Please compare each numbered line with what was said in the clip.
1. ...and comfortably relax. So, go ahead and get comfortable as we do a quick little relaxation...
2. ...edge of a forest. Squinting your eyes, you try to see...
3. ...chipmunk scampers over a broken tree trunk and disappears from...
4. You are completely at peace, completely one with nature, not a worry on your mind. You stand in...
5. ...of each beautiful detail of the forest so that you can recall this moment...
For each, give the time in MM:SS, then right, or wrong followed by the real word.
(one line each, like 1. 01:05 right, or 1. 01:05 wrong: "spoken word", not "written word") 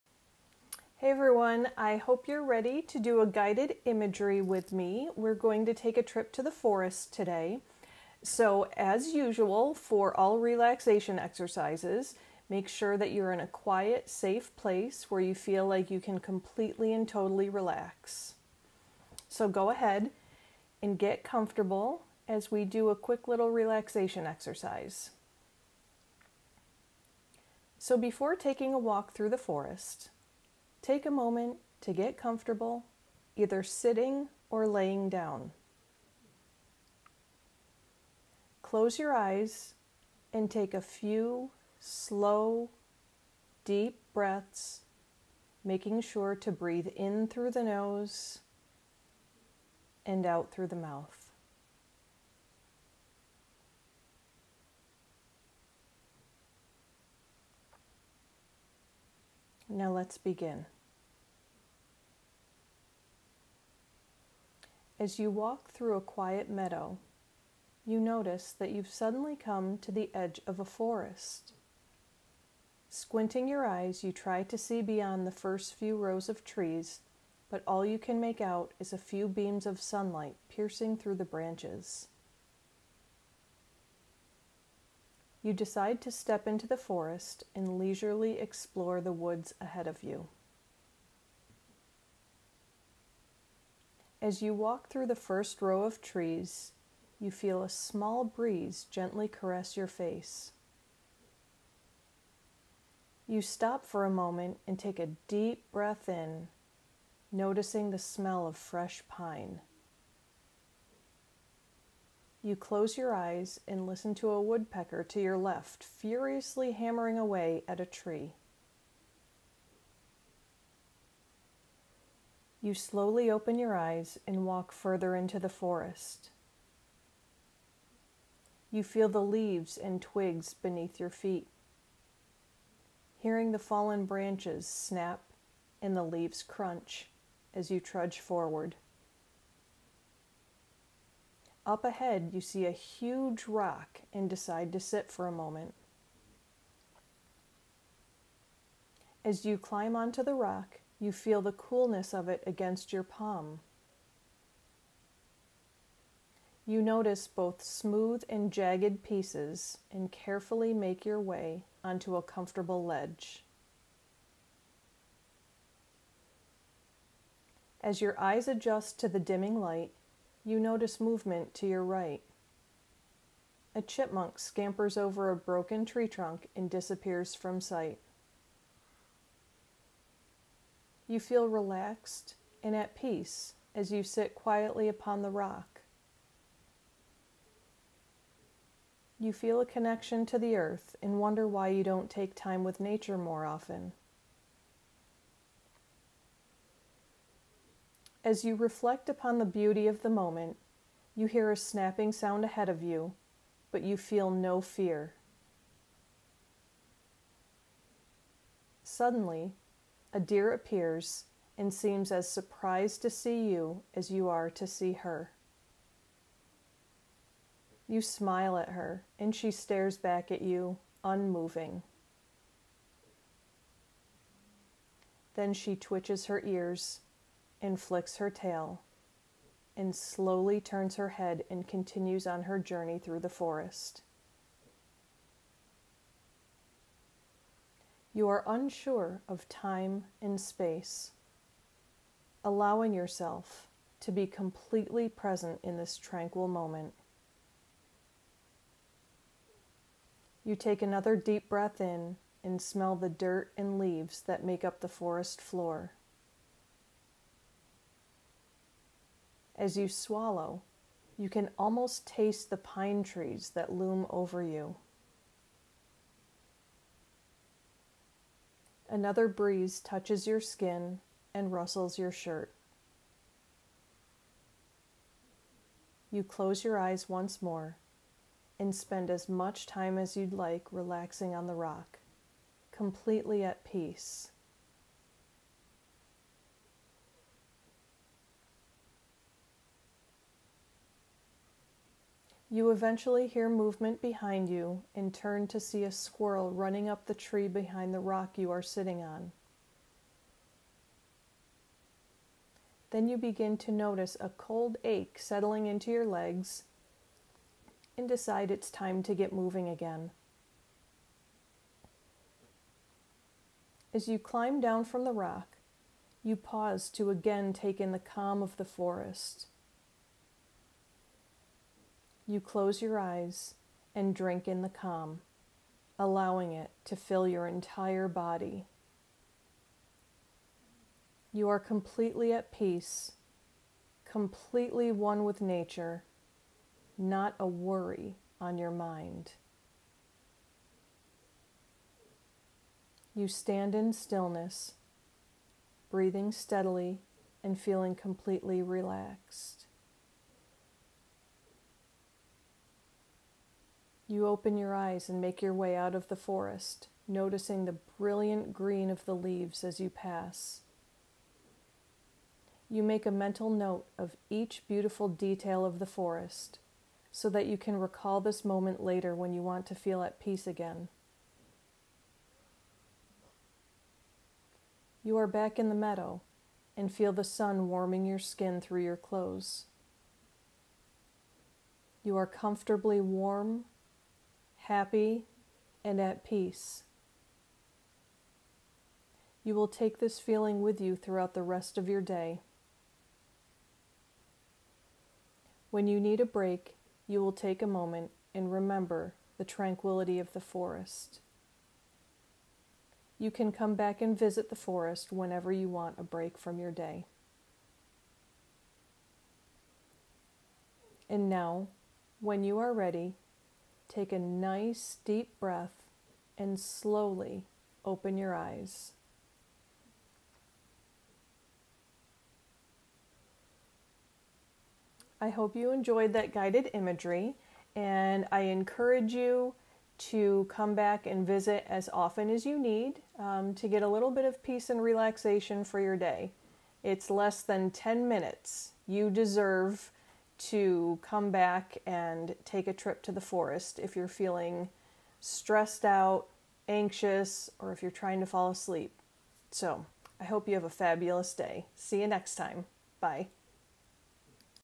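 1. 00:16 wrong: "totally", not "comfortably"
2. 01:10 right
3. 02:53 right
4. 05:31 right
5. 06:03 right.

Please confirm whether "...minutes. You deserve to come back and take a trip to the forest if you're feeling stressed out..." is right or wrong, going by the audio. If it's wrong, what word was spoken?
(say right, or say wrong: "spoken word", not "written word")
right.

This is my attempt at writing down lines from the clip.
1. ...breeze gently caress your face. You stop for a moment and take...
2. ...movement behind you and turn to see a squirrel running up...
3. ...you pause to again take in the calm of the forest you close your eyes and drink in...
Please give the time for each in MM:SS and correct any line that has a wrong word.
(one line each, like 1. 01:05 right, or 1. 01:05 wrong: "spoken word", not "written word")
1. 01:38 right
2. 04:53 right
3. 05:16 right.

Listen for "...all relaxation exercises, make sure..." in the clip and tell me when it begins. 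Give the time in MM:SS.
00:10.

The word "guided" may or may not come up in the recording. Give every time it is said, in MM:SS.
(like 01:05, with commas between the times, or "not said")
00:03, 07:06.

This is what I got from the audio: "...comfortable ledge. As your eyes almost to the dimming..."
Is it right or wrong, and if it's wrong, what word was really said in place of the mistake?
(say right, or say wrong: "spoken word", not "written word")
wrong: "adjust", not "almost".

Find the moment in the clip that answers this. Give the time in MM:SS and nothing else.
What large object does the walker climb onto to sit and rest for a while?
02:22.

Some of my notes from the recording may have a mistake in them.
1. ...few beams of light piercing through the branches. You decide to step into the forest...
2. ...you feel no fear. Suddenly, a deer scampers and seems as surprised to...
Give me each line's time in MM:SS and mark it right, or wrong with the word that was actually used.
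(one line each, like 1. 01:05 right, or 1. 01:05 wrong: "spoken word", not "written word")
1. 01:18 wrong: "sunlight", not "light"
2. 03:23 wrong: "appears", not "scampers".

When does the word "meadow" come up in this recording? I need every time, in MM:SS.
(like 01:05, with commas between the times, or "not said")
01:06, 06:15.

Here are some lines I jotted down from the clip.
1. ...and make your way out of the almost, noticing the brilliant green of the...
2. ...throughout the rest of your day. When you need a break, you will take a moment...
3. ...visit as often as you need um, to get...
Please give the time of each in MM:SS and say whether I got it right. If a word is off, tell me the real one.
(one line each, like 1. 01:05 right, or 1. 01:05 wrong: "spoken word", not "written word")
1. 05:55 wrong: "forest", not "almost"
2. 06:30 right
3. 07:11 right.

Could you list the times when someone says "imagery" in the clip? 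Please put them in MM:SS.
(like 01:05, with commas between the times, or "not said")
00:03, 07:06.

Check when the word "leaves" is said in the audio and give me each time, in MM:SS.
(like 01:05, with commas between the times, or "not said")
02:09, 02:16, 04:13, 05:59.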